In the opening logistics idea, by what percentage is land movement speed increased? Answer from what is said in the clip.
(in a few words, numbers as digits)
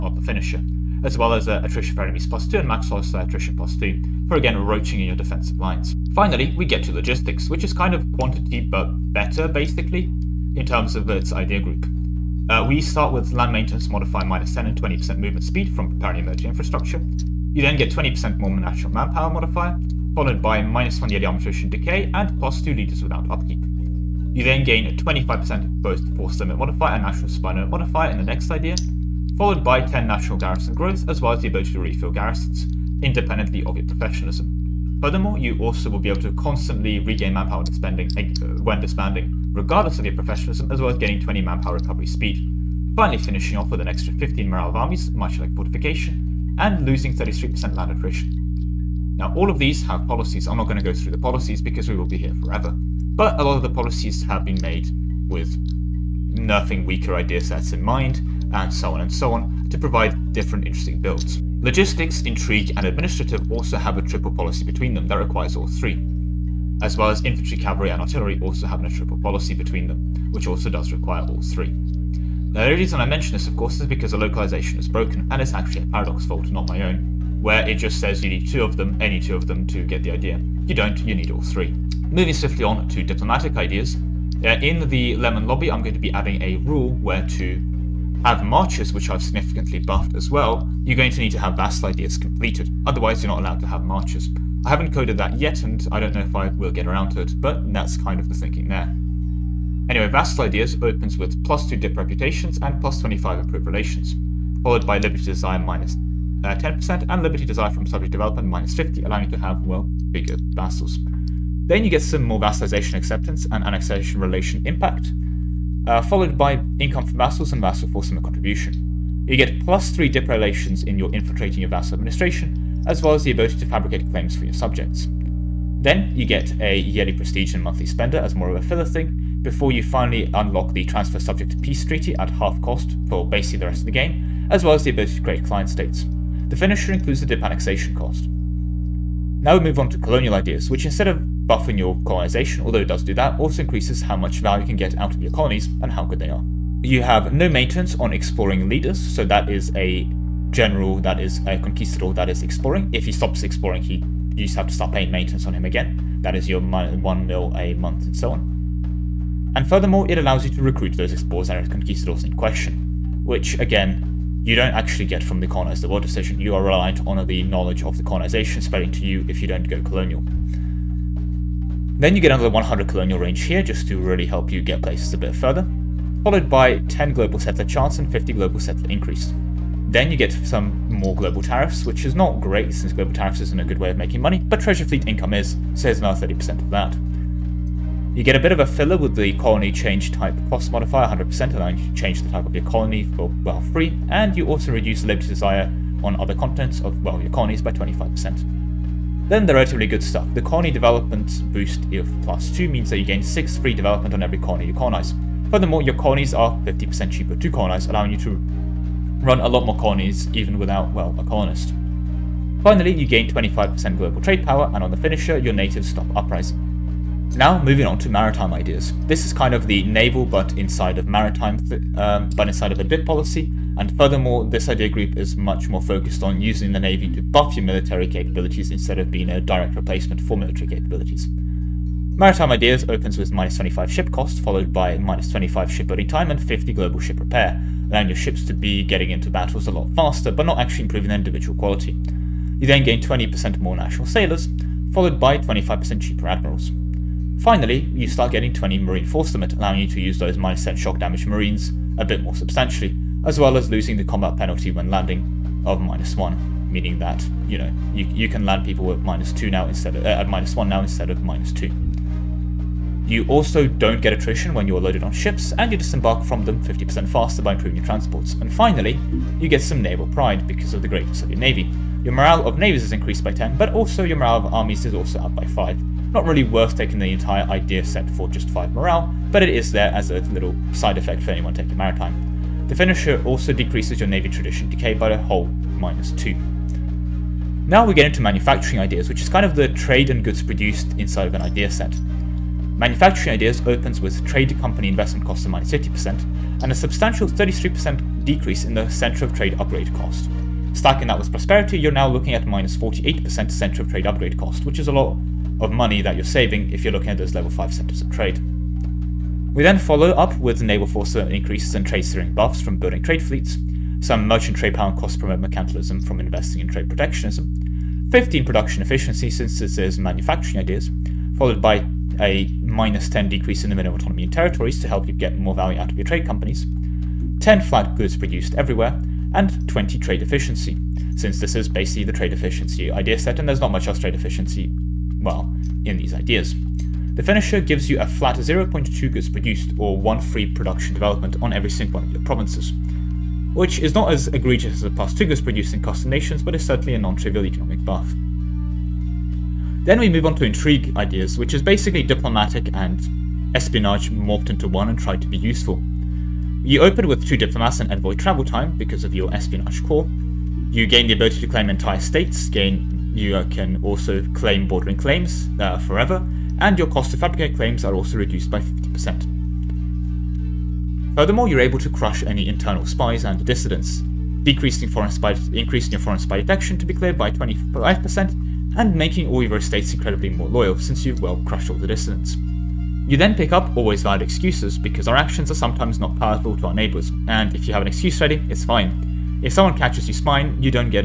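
20%.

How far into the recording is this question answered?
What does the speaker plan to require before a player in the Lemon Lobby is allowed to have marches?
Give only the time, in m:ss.
1:31.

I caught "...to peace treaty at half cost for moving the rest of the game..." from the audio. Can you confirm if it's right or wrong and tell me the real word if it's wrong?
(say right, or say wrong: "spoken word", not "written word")
wrong: "basing", not "moving".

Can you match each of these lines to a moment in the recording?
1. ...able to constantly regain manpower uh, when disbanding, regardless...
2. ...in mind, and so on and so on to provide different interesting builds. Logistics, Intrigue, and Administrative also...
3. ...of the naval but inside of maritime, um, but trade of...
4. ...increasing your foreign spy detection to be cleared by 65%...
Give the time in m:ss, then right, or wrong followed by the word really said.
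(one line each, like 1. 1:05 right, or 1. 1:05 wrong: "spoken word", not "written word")
1. 0:36 right
2. 0:57 right
3. 3:39 wrong: "inside", not "trade"
4. 6:15 wrong: "25", not "65".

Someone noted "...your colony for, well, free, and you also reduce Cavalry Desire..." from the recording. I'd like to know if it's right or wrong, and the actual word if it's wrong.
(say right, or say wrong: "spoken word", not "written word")
wrong: "Liberty", not "Cavalry".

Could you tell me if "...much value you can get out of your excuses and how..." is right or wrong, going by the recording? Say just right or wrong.
wrong.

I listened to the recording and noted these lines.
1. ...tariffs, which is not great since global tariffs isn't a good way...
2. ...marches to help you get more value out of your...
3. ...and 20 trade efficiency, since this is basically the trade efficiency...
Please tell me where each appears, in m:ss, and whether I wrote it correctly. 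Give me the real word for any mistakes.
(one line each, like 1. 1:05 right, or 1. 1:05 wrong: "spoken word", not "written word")
1. 3:01 right
2. 5:24 wrong: "territories", not "marches"
3. 5:29 right.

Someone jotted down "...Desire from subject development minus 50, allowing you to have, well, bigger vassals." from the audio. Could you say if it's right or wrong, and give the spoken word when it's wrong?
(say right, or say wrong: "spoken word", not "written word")
right.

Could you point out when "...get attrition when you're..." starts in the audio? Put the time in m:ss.
4:24.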